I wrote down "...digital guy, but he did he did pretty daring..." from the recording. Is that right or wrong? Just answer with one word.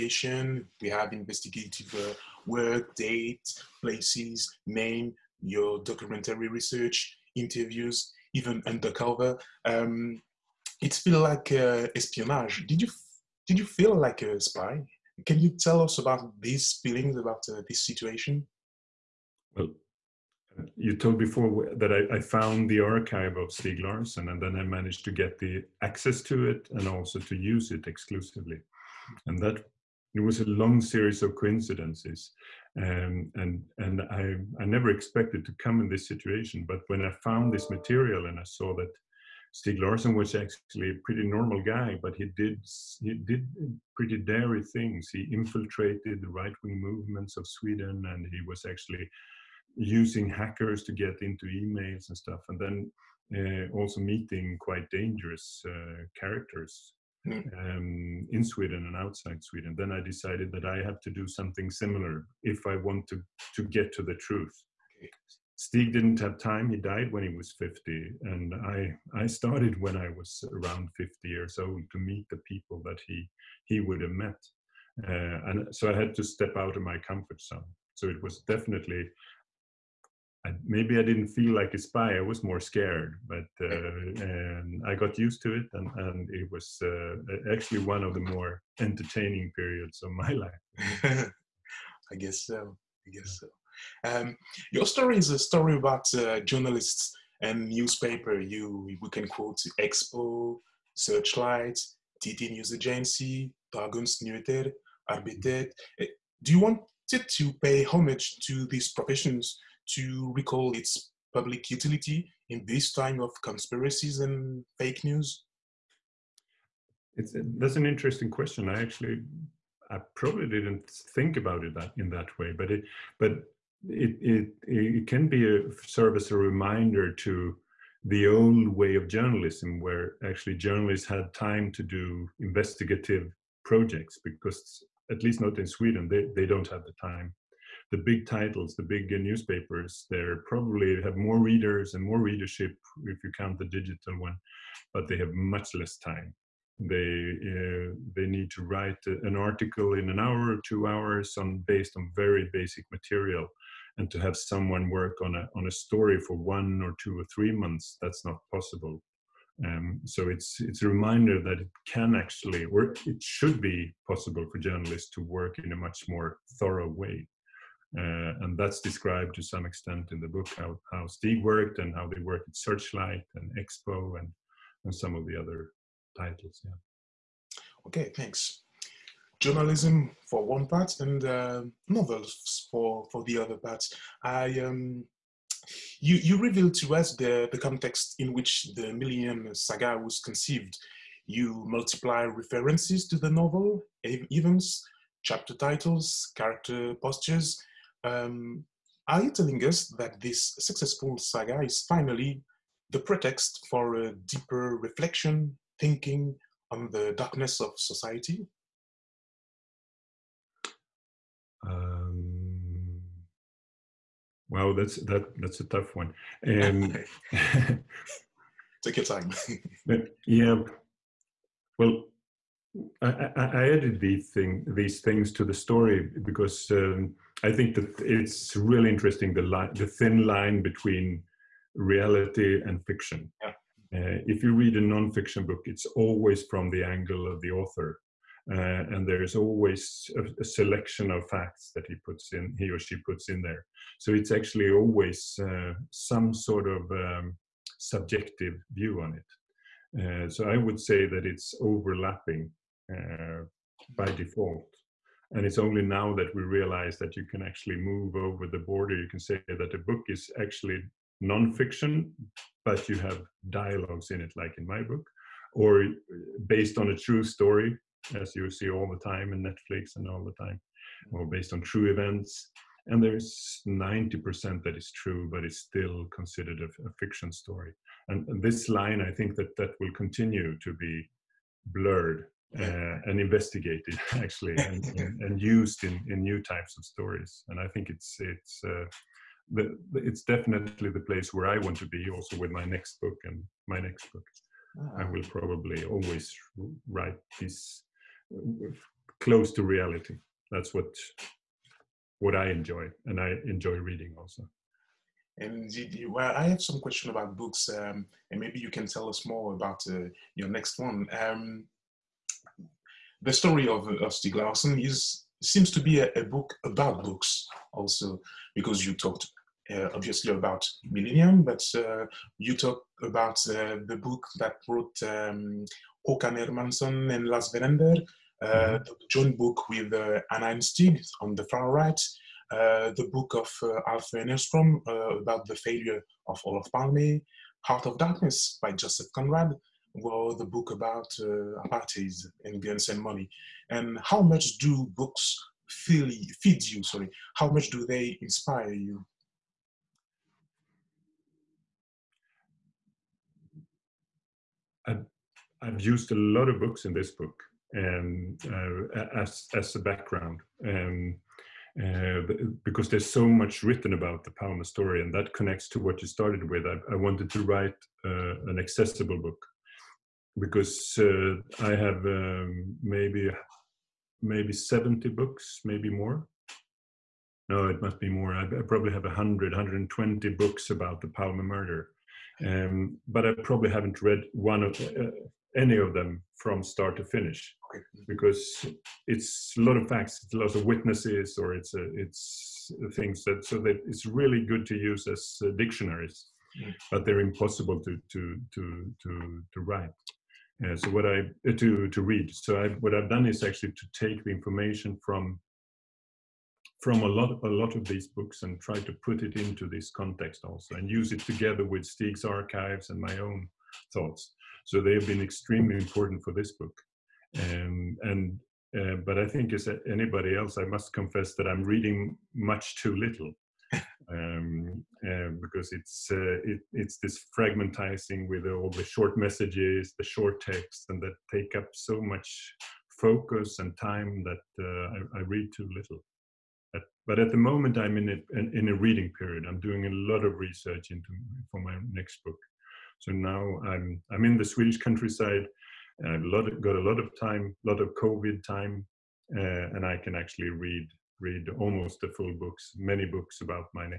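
wrong.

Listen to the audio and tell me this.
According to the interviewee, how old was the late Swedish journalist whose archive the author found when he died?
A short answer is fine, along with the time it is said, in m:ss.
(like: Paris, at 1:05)
50, at 1:06.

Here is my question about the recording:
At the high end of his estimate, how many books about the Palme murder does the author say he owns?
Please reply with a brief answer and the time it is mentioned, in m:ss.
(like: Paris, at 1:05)
120, at 6:19.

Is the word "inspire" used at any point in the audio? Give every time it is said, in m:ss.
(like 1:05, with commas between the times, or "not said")
5:48.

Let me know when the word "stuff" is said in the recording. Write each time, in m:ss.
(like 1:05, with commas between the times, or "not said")
0:52.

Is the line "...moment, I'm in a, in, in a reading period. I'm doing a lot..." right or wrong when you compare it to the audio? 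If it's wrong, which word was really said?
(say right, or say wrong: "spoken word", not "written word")
right.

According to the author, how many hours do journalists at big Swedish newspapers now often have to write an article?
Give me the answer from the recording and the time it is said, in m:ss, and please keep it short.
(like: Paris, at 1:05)
1 or 2 hours, at 2:30.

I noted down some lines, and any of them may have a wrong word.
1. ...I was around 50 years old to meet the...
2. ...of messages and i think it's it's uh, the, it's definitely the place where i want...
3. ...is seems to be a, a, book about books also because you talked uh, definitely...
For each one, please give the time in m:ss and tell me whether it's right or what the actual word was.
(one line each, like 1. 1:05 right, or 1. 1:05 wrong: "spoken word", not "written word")
1. 1:09 right
2. 4:46 wrong: "stories", not "messages"
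3. 5:14 wrong: "obviously", not "definitely".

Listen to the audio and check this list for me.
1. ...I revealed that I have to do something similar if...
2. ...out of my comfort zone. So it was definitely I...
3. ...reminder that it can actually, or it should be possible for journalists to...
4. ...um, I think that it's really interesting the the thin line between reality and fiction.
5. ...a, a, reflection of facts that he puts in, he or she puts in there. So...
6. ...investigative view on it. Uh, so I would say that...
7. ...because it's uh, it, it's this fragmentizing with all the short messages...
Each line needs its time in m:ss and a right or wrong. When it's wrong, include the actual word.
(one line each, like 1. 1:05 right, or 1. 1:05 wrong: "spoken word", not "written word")
1. 0:59 wrong: "decided", not "revealed"
2. 1:16 right
3. 2:40 right
4. 3:46 right
5. 4:00 wrong: "selection", not "reflection"
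6. 4:07 wrong: "subjective", not "investigative"
7. 7:05 right.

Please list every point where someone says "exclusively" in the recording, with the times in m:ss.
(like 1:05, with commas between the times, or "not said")
0:27.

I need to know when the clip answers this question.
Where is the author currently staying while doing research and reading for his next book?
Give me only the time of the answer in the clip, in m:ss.
7:24.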